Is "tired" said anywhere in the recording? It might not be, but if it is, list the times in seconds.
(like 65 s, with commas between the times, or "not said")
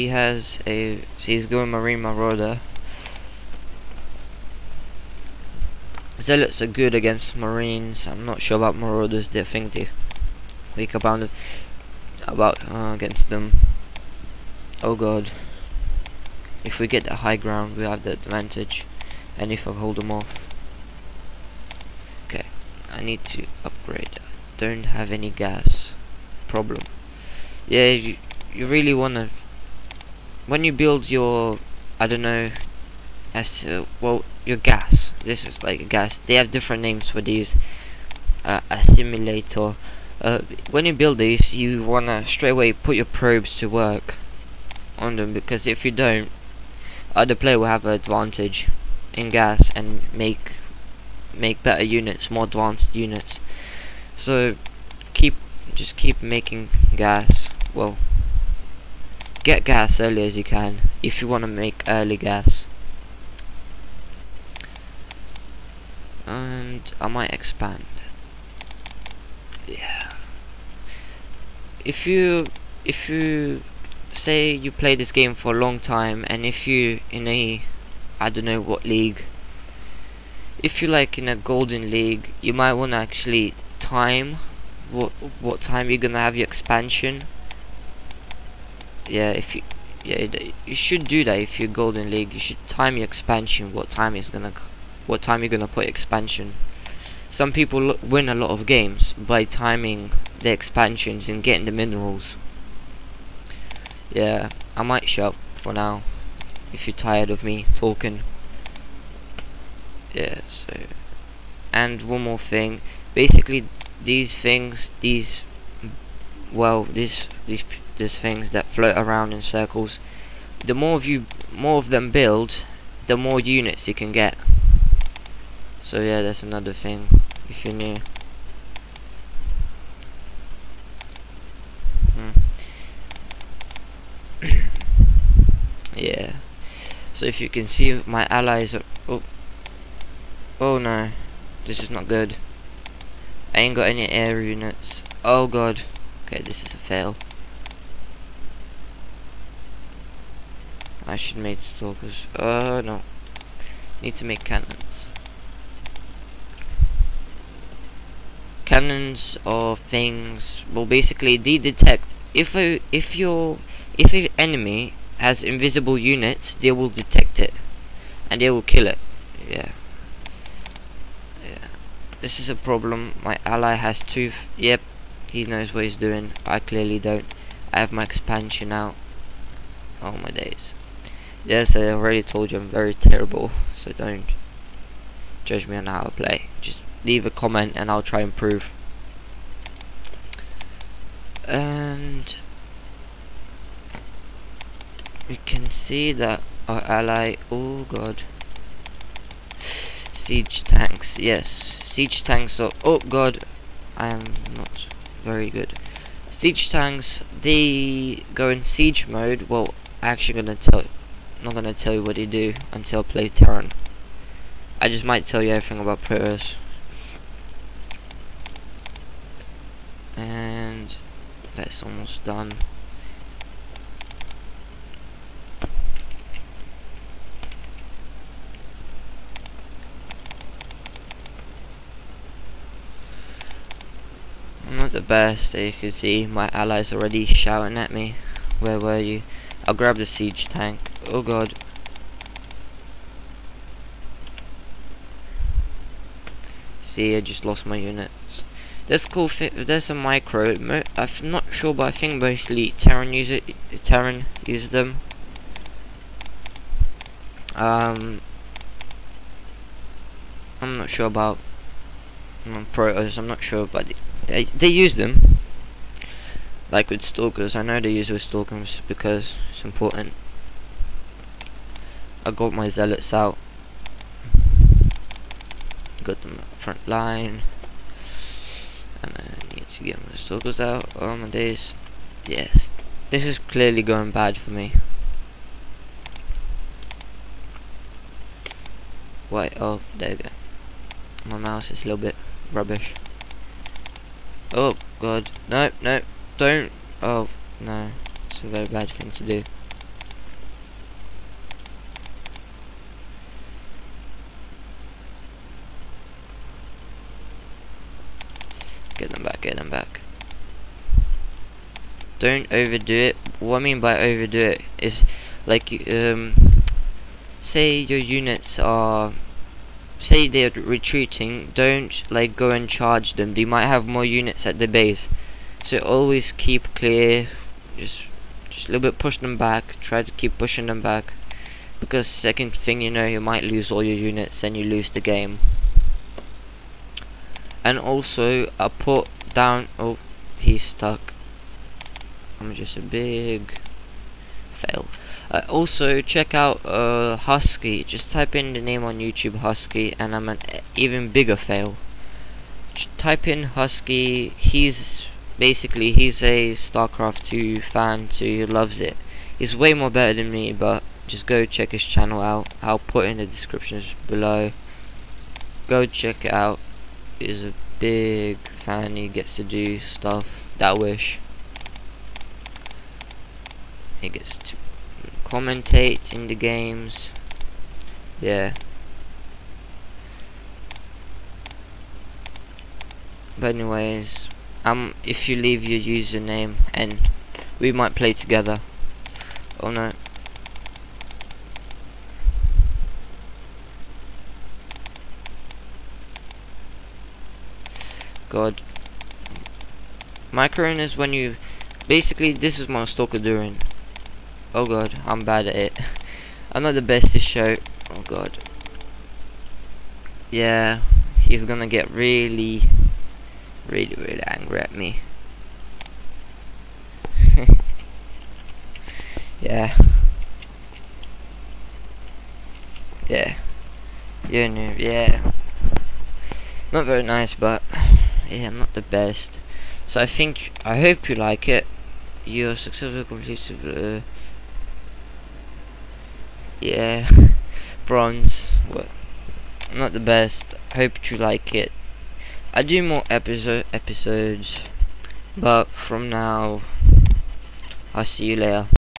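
106 s.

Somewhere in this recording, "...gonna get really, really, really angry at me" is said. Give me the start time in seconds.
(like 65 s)
411 s.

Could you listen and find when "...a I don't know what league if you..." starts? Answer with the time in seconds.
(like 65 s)
77 s.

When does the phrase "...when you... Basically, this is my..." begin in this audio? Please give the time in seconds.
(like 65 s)
400 s.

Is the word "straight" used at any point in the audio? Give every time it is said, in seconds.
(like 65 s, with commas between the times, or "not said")
42 s.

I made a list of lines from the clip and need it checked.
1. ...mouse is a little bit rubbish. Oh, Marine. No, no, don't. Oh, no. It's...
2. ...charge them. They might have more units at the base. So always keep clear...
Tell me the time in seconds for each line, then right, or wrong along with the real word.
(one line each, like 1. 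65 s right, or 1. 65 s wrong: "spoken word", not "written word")
1. 291 s wrong: "God", not "Marine"
2. 322 s right.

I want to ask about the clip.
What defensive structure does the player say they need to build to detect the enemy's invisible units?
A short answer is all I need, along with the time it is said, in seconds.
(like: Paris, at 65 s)
cannons, at 154 s.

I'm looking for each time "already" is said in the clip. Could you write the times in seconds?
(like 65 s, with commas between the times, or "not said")
181 s, 236 s.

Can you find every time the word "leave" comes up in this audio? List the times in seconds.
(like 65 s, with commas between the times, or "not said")
187 s, 385 s.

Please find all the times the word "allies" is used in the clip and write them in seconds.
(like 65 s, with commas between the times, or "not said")
138 s, 236 s.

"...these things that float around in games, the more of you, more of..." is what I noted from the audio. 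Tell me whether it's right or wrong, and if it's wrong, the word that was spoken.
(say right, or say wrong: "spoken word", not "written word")
wrong: "circles", not "games".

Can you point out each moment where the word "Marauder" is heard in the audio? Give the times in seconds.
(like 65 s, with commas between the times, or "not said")
2 s, 8 s.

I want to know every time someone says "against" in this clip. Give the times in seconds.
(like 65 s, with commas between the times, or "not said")
6 s, 12 s.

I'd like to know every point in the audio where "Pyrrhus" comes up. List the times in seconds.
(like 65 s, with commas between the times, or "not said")
216 s.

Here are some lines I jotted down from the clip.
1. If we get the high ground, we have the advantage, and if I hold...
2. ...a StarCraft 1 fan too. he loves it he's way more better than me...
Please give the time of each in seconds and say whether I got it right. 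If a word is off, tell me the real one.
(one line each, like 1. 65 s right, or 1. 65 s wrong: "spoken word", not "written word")
1. 16 s right
2. 356 s wrong: "2", not "1".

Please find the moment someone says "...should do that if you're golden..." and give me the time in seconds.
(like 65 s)
90 s.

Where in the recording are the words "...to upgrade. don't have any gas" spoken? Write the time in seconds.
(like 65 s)
23 s.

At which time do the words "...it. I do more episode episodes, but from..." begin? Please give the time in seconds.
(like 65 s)
441 s.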